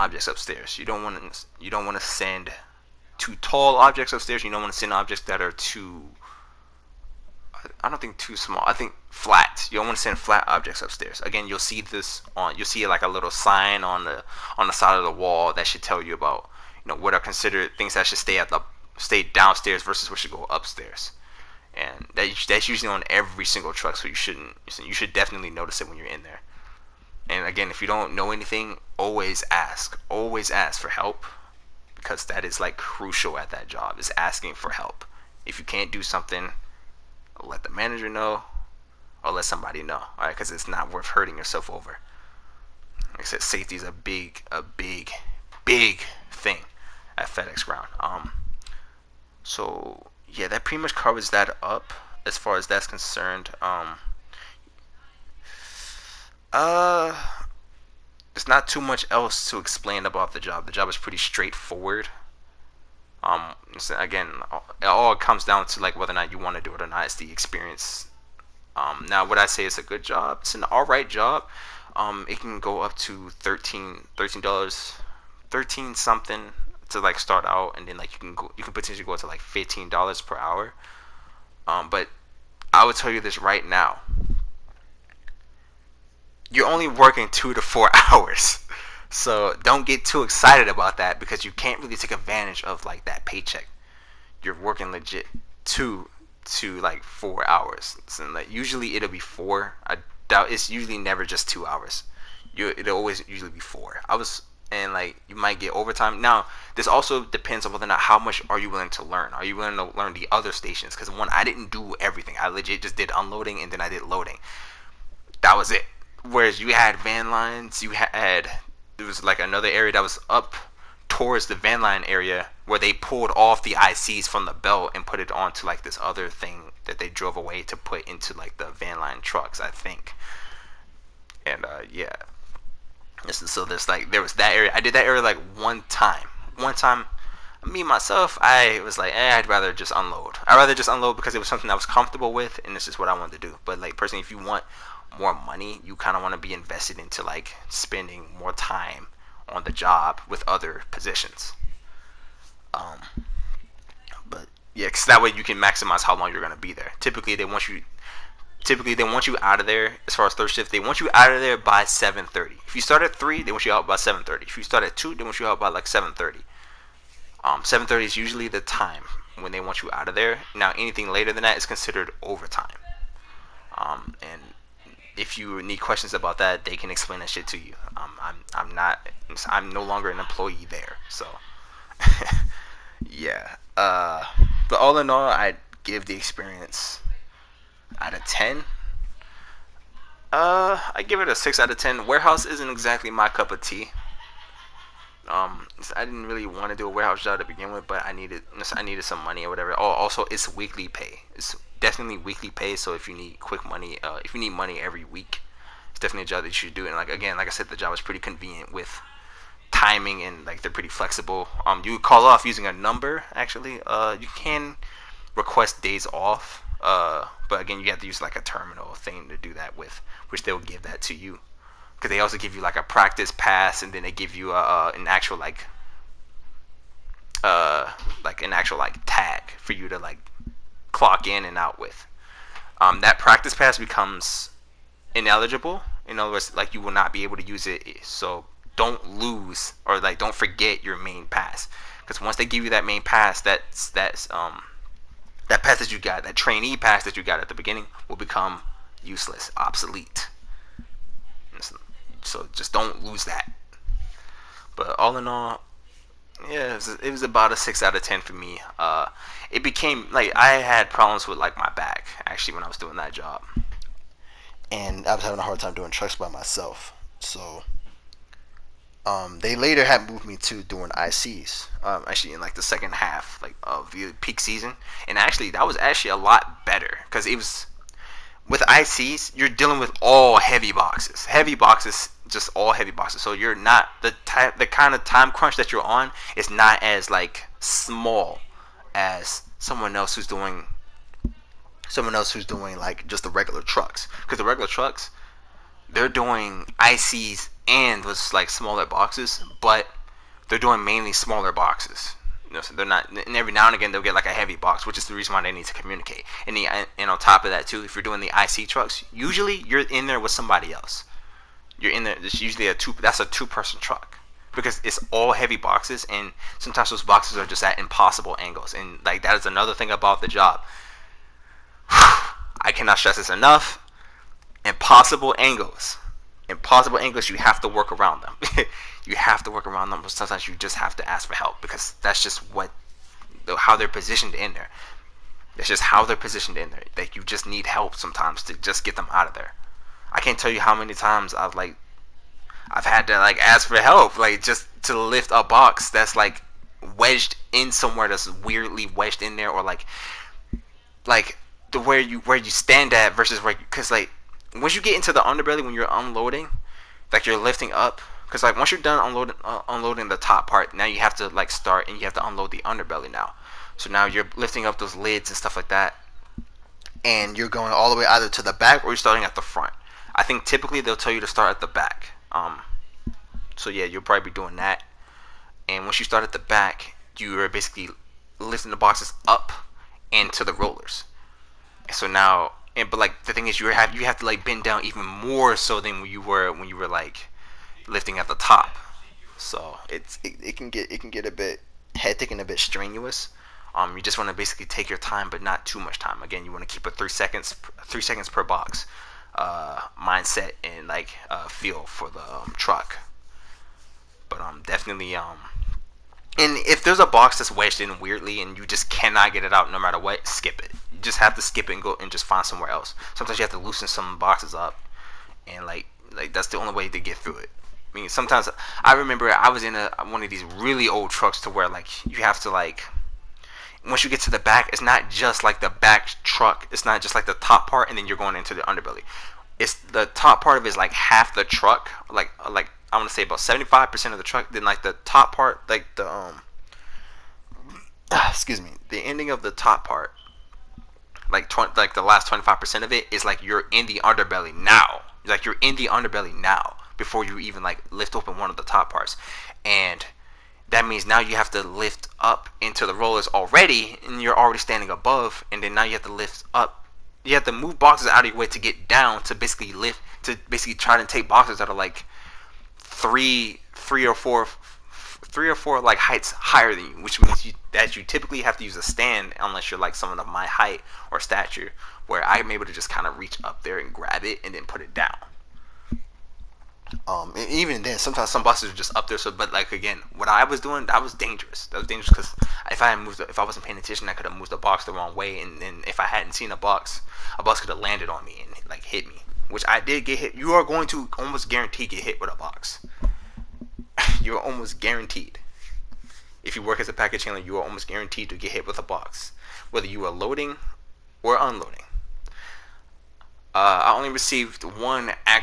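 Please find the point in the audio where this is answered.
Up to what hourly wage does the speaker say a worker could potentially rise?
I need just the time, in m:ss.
1:19.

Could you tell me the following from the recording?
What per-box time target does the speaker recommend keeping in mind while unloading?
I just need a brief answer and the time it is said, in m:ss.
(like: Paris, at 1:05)
3 seconds, at 6:37.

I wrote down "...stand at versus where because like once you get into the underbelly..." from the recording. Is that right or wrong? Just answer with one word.
right.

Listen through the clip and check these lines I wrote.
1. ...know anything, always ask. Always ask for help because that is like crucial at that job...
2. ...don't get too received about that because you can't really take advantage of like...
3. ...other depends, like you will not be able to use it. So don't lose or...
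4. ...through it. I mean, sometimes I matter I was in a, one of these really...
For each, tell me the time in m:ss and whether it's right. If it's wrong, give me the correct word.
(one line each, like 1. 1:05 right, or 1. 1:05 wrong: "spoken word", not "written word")
1. 0:28 right
2. 1:29 wrong: "excited", not "received"
3. 3:56 wrong: "words", not "depends"
4. 6:57 wrong: "remember", not "matter".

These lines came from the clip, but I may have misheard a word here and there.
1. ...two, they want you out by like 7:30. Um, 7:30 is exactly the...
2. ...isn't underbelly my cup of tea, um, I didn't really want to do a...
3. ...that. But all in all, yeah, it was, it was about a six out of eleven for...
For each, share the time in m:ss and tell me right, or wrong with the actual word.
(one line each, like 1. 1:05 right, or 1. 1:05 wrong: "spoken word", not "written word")
1. 2:44 wrong: "usually", not "exactly"
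2. 3:12 wrong: "exactly", not "underbelly"
3. 4:13 wrong: "ten", not "eleven".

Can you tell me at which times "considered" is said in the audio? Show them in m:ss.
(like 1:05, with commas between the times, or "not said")
0:17, 2:51.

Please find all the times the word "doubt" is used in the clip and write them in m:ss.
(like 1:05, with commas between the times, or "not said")
1:40.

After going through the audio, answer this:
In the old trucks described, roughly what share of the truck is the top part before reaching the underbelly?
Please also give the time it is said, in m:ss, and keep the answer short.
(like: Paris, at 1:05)
75%, at 7:13.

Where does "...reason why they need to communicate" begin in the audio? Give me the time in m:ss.
5:05.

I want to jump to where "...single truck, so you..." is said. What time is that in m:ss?
0:23.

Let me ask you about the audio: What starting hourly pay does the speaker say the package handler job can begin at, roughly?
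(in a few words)
$13.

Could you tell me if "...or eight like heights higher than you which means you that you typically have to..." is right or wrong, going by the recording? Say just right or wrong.
wrong.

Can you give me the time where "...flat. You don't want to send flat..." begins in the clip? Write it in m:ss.
0:09.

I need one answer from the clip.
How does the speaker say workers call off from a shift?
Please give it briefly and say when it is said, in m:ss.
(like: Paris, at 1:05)
A number, at 3:32.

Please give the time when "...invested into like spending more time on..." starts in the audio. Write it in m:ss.
2:26.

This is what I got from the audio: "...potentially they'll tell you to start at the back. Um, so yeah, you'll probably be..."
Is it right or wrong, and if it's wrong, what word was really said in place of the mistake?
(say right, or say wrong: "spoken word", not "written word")
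wrong: "typically", not "potentially".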